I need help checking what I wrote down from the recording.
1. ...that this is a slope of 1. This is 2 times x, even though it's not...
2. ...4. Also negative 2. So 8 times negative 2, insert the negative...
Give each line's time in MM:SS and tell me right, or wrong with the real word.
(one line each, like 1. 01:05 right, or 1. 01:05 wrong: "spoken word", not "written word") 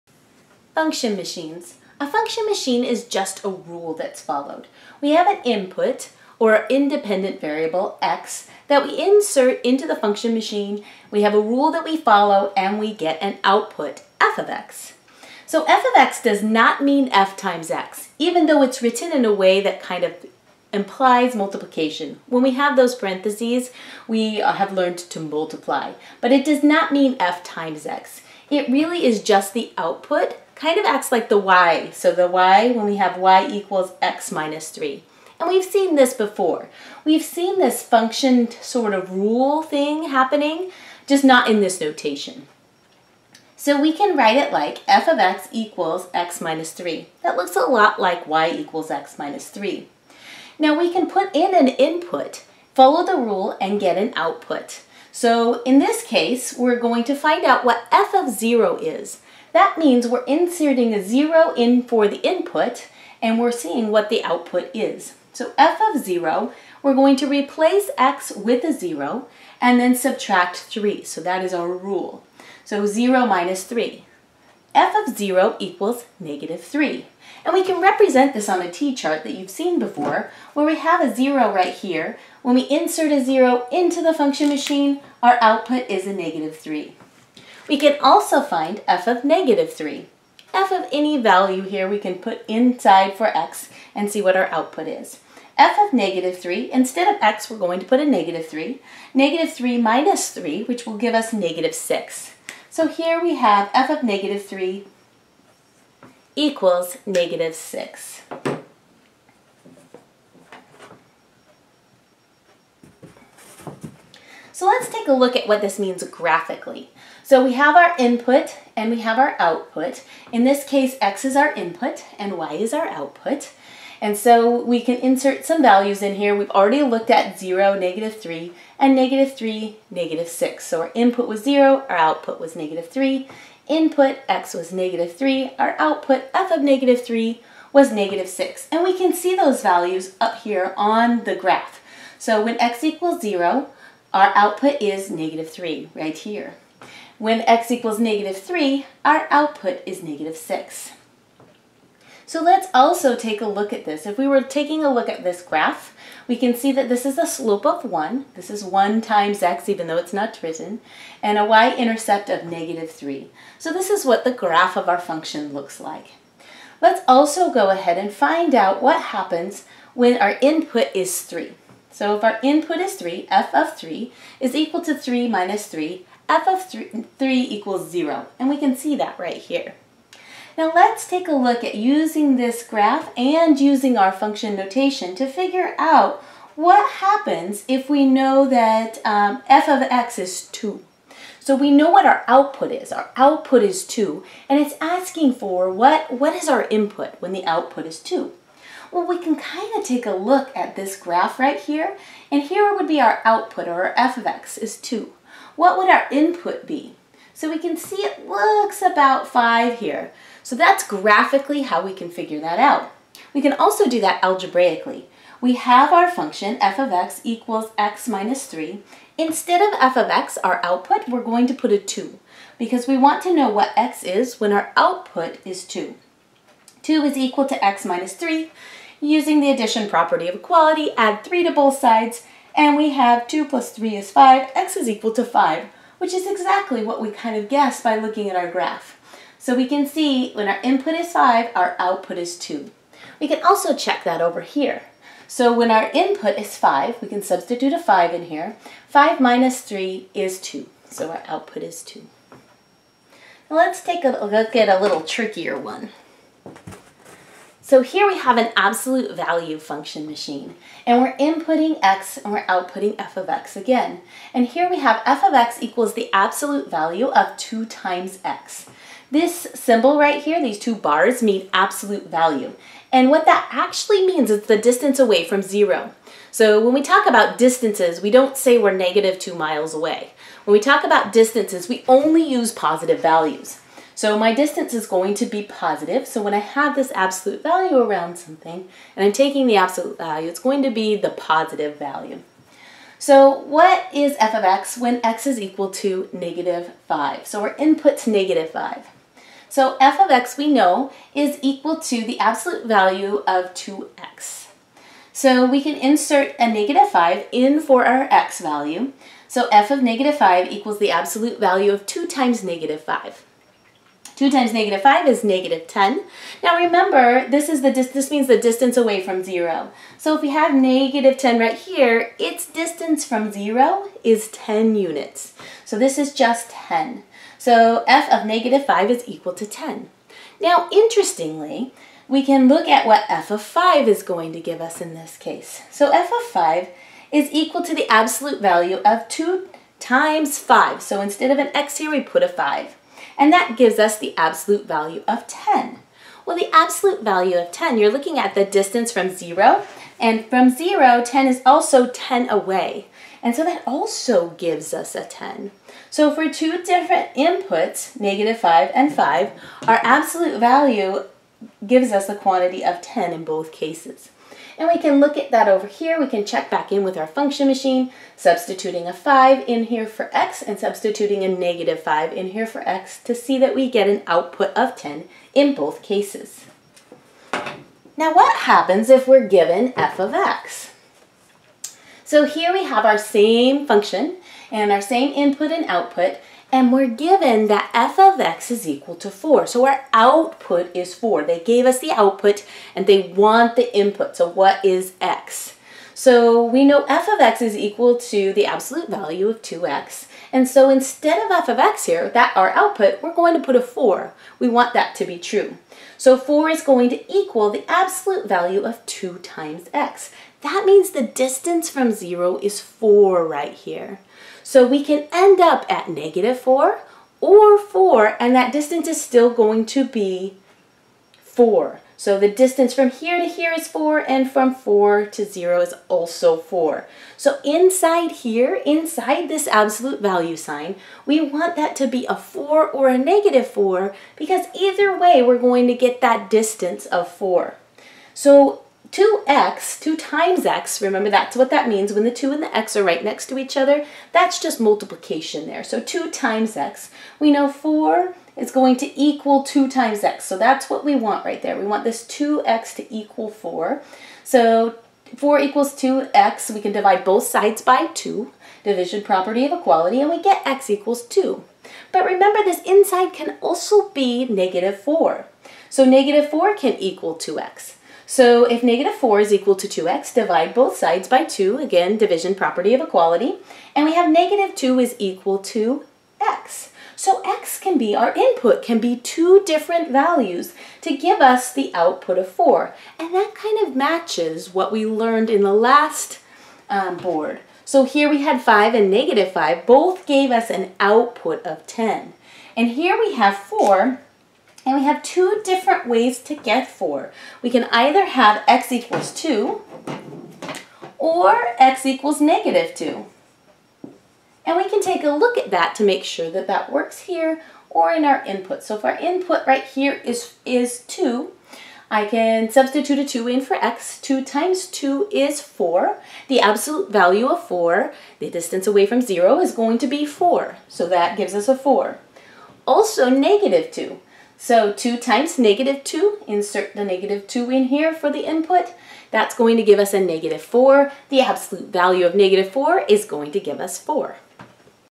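1. 02:36 wrong: "1", not "2"
2. 08:41 wrong: "2", not "8".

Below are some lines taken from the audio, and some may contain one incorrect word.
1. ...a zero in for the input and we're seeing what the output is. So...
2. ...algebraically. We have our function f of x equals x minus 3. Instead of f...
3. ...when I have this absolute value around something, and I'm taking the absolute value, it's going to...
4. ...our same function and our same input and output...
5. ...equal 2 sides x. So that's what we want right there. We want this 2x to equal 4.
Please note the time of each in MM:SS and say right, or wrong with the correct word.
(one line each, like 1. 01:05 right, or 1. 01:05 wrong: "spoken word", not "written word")
1. 01:00 right
2. 03:34 right
3. 04:46 right
4. 06:22 right
5. 07:29 wrong: "times", not "sides".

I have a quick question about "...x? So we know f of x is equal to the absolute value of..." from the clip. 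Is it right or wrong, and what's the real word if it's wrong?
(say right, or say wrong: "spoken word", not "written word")
right.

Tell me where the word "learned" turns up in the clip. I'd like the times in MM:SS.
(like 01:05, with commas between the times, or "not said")
00:24, 08:04.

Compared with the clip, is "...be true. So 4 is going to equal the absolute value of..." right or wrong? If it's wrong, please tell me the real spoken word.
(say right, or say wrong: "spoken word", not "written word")
right.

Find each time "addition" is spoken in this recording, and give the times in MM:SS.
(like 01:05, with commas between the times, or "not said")
03:49.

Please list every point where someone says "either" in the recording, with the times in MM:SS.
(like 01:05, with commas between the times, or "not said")
07:14, 08:17.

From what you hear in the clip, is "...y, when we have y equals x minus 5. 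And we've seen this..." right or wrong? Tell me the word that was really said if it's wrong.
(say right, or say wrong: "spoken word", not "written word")
wrong: "3", not "5".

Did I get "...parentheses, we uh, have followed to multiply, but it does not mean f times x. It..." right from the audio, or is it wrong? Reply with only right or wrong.
wrong.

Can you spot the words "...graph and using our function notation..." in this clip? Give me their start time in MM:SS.
03:02.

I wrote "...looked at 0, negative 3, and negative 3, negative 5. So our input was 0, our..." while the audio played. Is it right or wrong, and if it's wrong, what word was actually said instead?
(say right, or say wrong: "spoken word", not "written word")
wrong: "6", not "5".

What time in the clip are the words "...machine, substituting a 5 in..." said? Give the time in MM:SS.
06:07.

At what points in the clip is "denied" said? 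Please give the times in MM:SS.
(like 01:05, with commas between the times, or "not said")
not said.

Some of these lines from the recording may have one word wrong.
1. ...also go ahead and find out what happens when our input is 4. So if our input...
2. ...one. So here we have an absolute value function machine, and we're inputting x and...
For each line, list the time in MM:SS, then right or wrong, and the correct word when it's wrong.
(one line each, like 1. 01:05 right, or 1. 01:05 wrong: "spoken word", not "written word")
1. 02:47 wrong: "3", not "4"
2. 04:15 right.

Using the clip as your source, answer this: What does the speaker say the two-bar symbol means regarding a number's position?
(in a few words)
distance away from zero.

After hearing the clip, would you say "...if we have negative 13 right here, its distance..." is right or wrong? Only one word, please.
wrong.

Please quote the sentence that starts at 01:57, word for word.
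So we have our input and we have our output.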